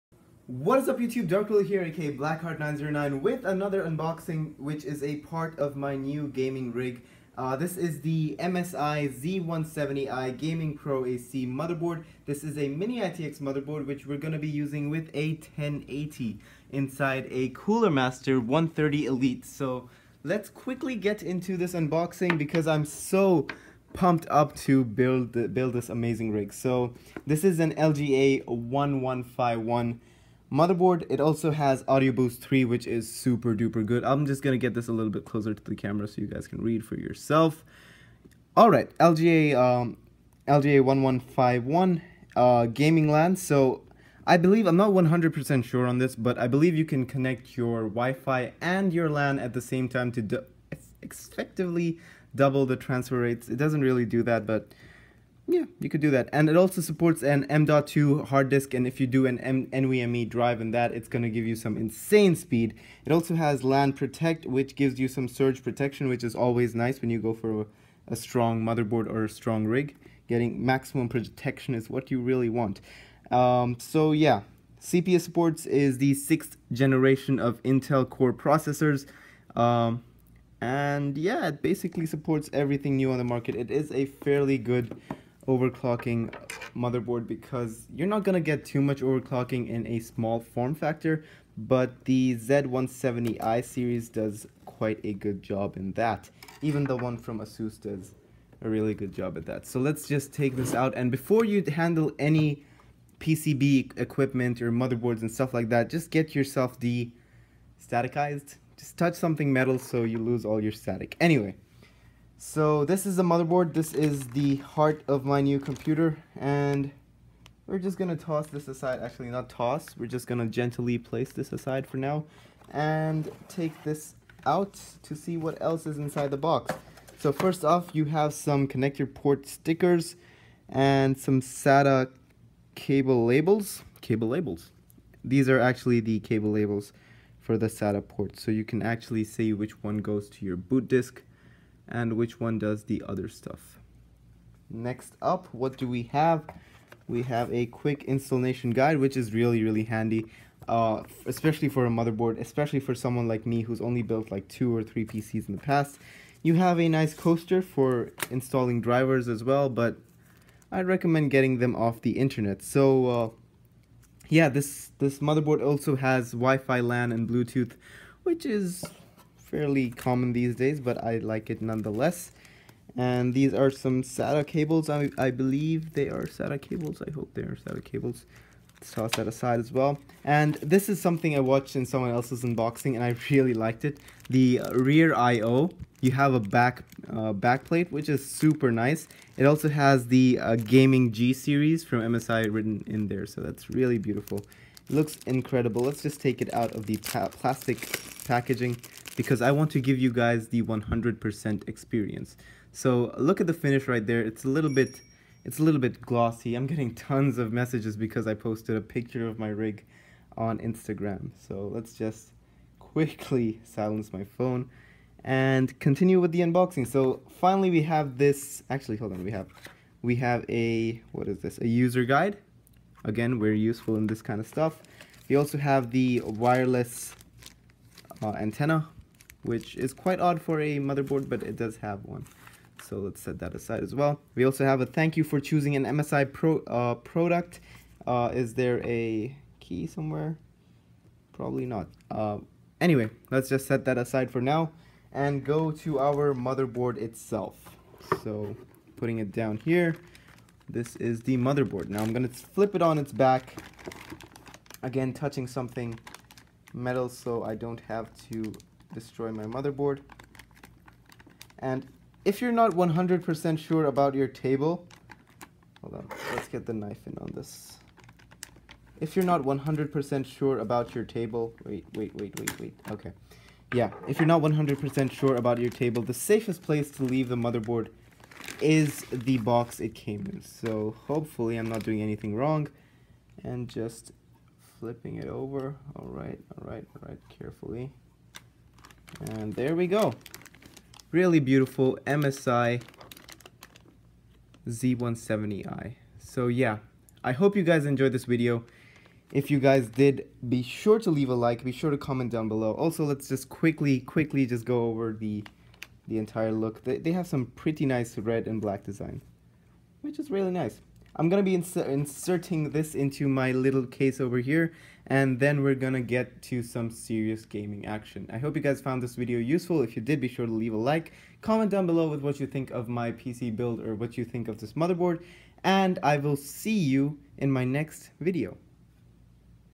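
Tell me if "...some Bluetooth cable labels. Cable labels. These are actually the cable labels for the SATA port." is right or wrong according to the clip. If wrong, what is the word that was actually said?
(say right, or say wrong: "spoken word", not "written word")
wrong: "SATA", not "Bluetooth".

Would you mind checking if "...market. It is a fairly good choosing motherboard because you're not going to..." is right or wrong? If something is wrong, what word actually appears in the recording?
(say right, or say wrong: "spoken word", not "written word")
wrong: "overclocking", not "choosing".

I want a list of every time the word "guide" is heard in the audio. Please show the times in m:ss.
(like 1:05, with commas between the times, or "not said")
2:28, 3:42.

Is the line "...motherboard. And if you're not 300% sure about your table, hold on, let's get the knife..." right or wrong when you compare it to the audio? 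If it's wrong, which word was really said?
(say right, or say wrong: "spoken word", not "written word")
wrong: "100", not "300".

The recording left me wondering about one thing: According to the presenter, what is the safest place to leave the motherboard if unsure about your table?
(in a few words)
The box it came in.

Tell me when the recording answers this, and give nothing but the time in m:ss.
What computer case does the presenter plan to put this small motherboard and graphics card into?
0:17.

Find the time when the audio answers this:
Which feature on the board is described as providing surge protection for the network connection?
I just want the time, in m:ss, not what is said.
1:03.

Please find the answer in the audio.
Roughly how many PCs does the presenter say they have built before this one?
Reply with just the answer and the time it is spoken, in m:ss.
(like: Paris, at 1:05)
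2 or 3, at 2:34.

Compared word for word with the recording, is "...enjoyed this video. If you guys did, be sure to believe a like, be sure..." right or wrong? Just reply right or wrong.
wrong.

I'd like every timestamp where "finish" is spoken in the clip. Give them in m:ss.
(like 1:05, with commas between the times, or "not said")
3:23.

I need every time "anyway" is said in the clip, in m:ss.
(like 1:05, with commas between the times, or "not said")
1:51, 4:02.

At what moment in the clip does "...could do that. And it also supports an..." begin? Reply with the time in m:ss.
0:55.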